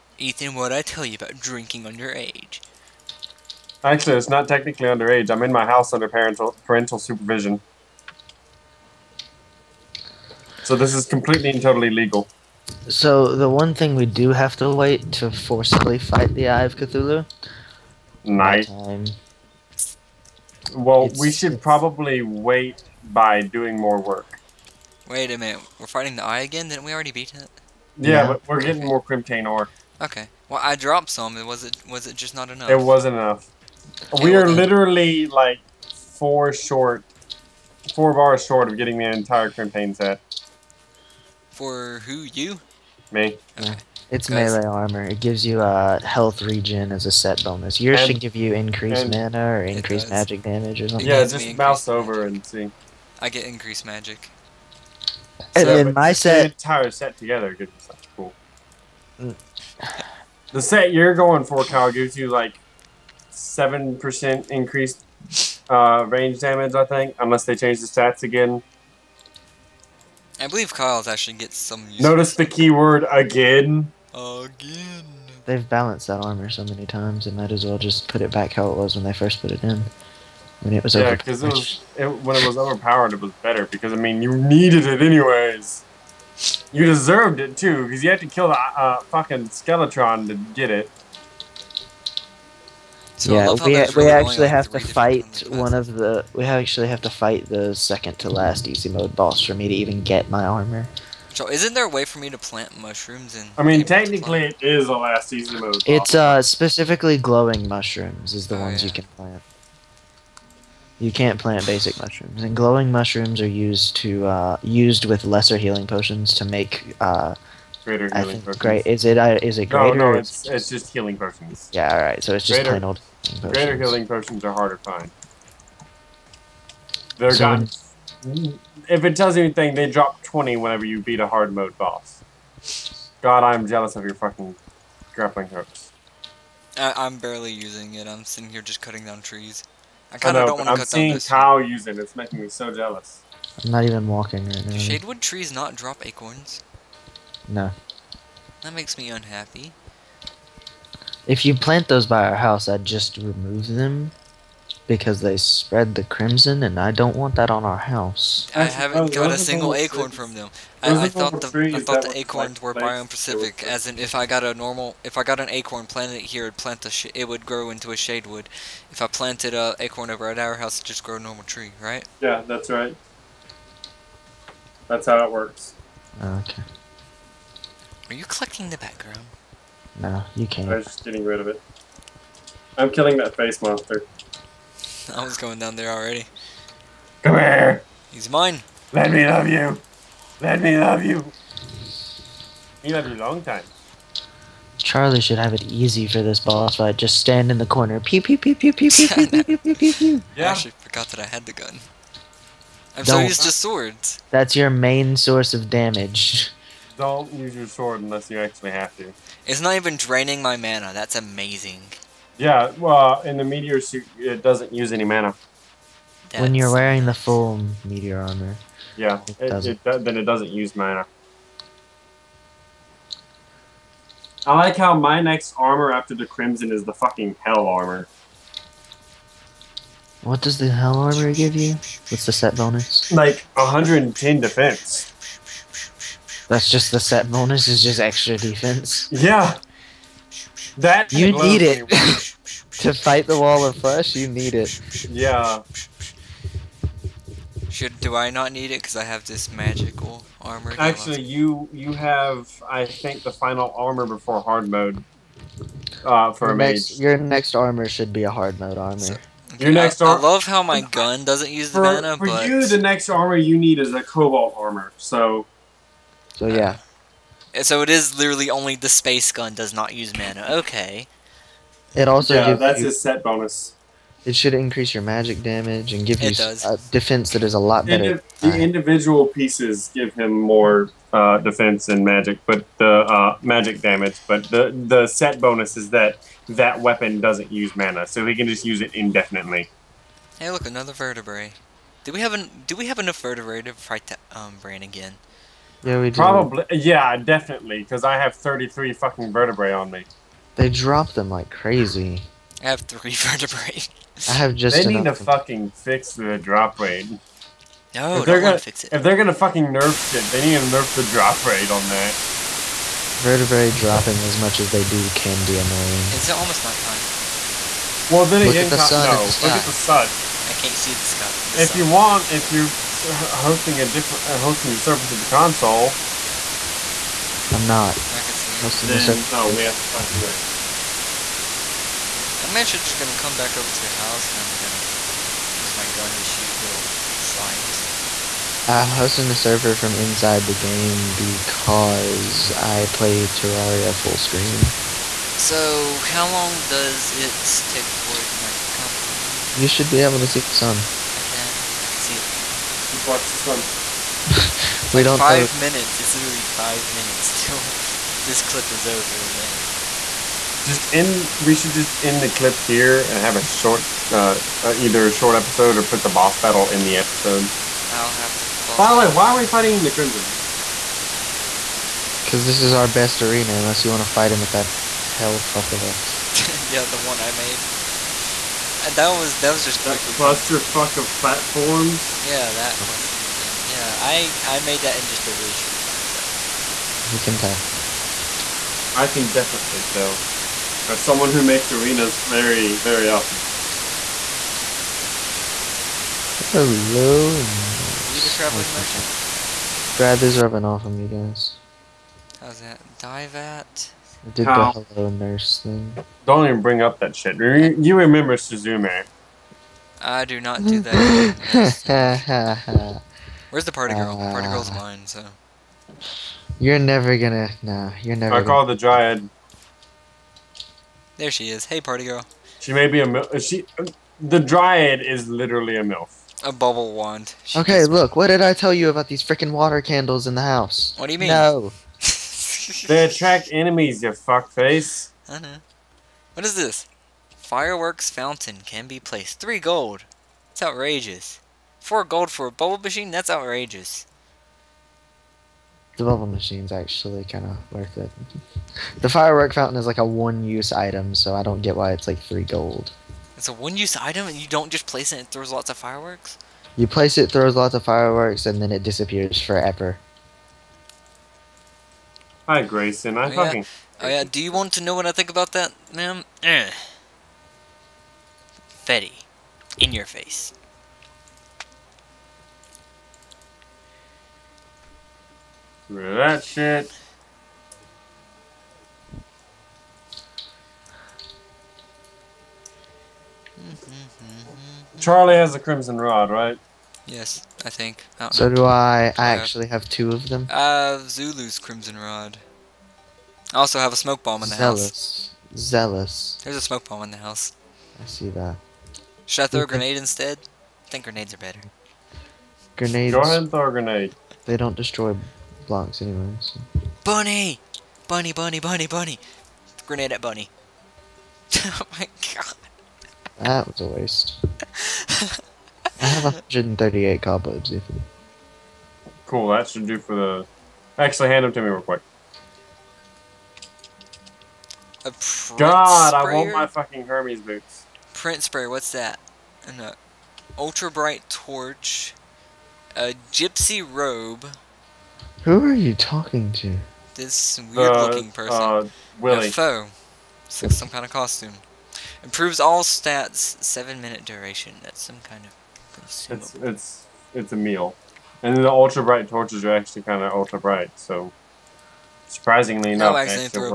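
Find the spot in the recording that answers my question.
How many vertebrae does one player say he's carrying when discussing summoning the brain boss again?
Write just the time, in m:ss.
4:58.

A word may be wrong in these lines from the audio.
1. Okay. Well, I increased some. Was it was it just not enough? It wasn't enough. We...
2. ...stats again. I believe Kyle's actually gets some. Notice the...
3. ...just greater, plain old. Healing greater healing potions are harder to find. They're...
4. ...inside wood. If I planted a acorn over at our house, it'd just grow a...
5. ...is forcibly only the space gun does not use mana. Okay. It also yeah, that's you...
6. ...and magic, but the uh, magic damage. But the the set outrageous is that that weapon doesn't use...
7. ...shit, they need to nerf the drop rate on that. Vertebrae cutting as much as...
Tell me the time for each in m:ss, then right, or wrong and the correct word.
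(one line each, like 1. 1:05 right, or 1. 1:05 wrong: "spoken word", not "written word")
1. 0:30 wrong: "dropped", not "increased"
2. 1:07 right
3. 2:02 right
4. 2:47 wrong: "shade", not "inside"
5. 4:27 wrong: "literally", not "forcibly"
6. 4:41 wrong: "bonus", not "outrageous"
7. 5:09 wrong: "dropping", not "cutting".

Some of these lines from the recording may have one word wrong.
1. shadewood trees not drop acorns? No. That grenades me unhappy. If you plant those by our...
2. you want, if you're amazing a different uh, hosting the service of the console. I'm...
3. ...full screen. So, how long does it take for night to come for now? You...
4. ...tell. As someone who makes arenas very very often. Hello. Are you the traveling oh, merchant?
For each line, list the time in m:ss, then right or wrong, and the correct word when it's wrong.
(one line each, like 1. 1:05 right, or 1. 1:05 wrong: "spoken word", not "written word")
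1. 2:24 wrong: "makes", not "grenades"
2. 5:21 wrong: "hosting", not "amazing"
3. 5:43 right
4. 6:29 right.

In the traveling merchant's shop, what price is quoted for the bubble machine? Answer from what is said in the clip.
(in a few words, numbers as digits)
4 gold.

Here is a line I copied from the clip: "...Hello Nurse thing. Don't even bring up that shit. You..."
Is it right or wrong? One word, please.
right.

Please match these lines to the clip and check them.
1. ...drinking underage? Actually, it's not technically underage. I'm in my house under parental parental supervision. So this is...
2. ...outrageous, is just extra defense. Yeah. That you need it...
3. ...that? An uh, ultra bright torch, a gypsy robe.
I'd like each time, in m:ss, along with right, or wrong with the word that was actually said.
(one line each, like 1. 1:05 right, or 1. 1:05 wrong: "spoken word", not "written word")
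1. 0:01 right
2. 3:57 wrong: "bonus", not "outrageous"
3. 8:48 right.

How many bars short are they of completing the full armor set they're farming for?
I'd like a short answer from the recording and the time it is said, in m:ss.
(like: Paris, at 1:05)
4, at 0:37.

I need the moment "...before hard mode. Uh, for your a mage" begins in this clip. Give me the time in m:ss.
4:14.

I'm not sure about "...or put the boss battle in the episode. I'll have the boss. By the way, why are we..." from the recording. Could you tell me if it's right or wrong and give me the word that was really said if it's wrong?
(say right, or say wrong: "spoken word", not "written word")
right.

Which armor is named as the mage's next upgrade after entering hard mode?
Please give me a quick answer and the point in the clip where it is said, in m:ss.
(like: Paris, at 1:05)
Cobalt armor, at 4:24.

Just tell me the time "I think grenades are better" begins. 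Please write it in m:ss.
8:20.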